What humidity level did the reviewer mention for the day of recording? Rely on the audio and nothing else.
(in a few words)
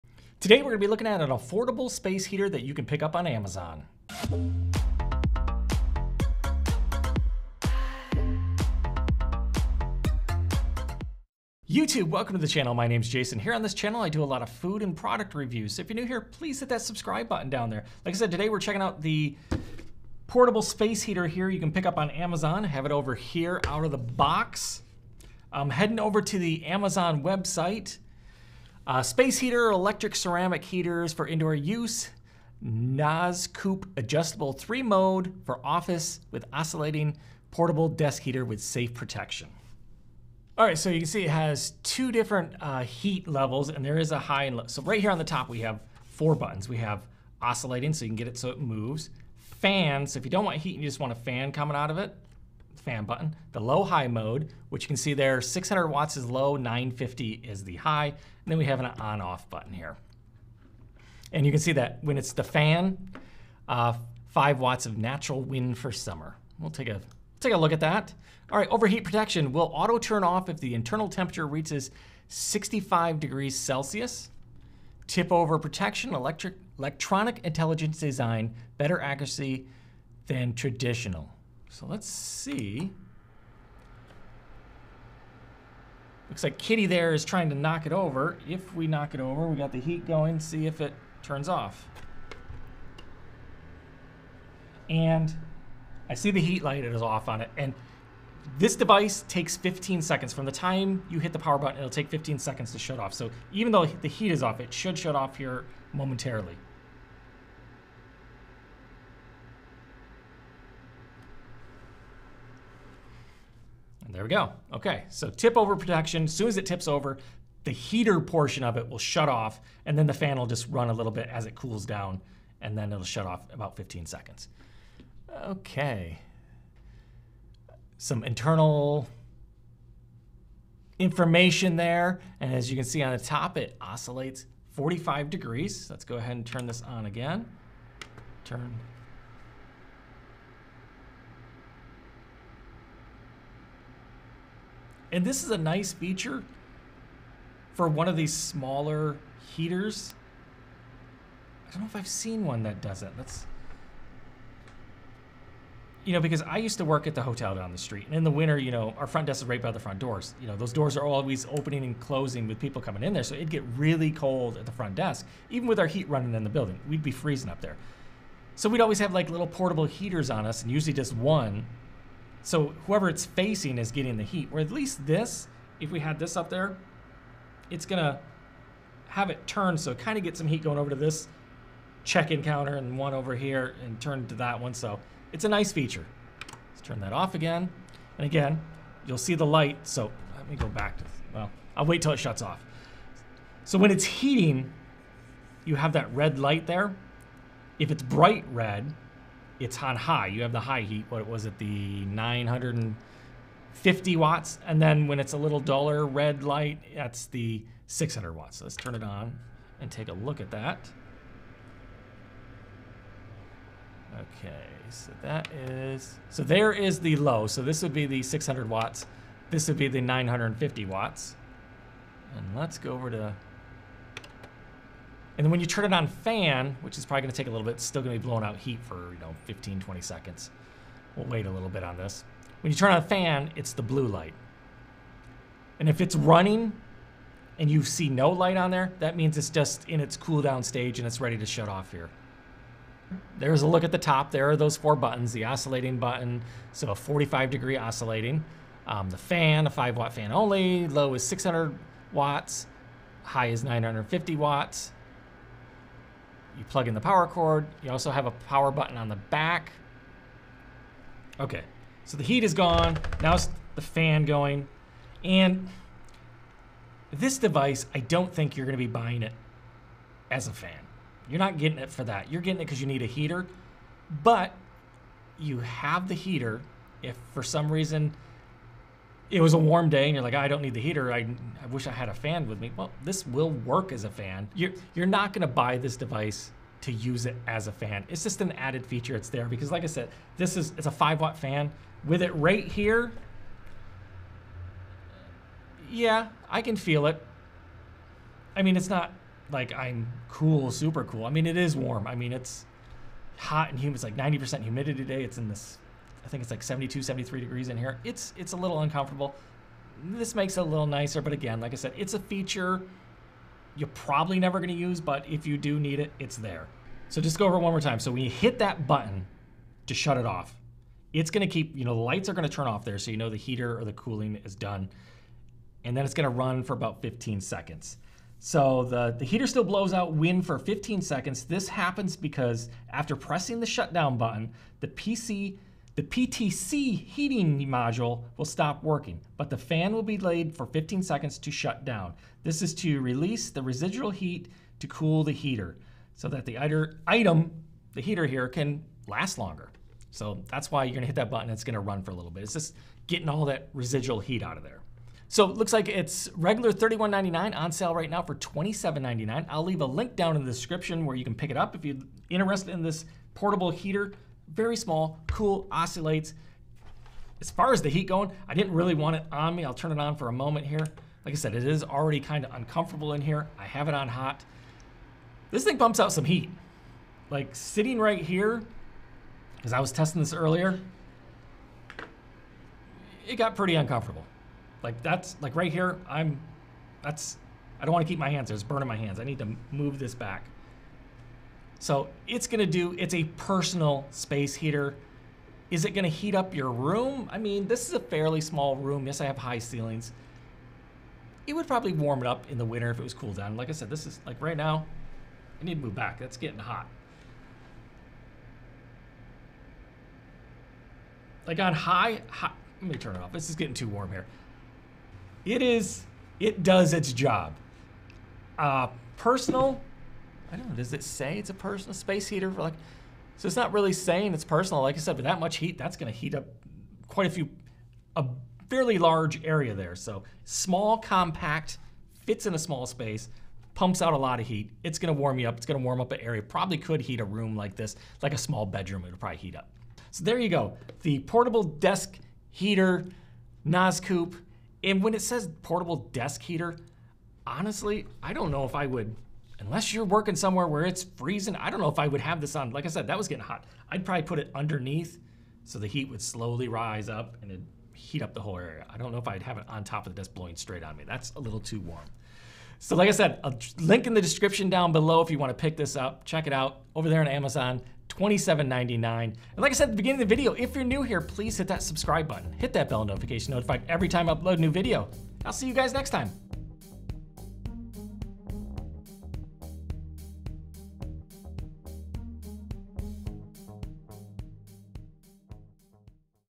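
90%.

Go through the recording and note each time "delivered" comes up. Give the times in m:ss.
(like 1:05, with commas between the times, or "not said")
not said.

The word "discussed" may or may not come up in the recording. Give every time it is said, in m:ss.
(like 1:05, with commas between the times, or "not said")
not said.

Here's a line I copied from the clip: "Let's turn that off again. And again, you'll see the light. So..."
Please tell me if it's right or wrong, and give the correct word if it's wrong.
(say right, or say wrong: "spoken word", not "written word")
right.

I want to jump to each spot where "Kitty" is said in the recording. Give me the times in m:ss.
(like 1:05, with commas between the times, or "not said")
1:26.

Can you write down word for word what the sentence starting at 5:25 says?
And then it's gonna run for about 15 seconds.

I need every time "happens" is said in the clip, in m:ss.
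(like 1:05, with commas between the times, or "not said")
5:31.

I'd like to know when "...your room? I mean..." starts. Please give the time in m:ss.
6:36.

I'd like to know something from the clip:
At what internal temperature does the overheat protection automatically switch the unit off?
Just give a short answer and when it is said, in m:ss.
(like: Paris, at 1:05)
65 degrees Celsius, at 1:12.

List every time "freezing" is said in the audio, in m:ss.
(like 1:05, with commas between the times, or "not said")
2:47, 7:31.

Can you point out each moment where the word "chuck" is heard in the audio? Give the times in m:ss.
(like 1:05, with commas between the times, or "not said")
not said.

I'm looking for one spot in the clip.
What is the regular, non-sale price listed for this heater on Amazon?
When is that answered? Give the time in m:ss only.
5:56.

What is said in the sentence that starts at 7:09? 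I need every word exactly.
So small, compact, fits in a small space, pumps out a lot of heat.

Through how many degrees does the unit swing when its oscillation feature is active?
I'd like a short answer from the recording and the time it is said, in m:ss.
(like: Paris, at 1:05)
45 degrees, at 2:14.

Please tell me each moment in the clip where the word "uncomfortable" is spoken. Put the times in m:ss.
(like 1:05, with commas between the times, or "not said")
5:08, 6:12, 6:23.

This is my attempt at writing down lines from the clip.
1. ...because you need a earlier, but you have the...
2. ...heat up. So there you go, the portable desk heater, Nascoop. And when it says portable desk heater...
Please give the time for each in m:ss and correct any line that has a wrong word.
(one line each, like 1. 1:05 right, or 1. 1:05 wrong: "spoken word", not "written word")
1. 4:32 wrong: "heater", not "earlier"
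2. 7:19 right.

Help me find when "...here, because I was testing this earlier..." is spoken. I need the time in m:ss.
6:18.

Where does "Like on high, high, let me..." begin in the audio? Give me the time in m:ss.
6:51.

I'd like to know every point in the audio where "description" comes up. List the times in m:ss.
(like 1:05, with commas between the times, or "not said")
6:00, 7:44.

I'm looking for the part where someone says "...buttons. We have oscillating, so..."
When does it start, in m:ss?
0:46.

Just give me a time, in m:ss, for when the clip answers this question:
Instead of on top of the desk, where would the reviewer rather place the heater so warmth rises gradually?
7:34.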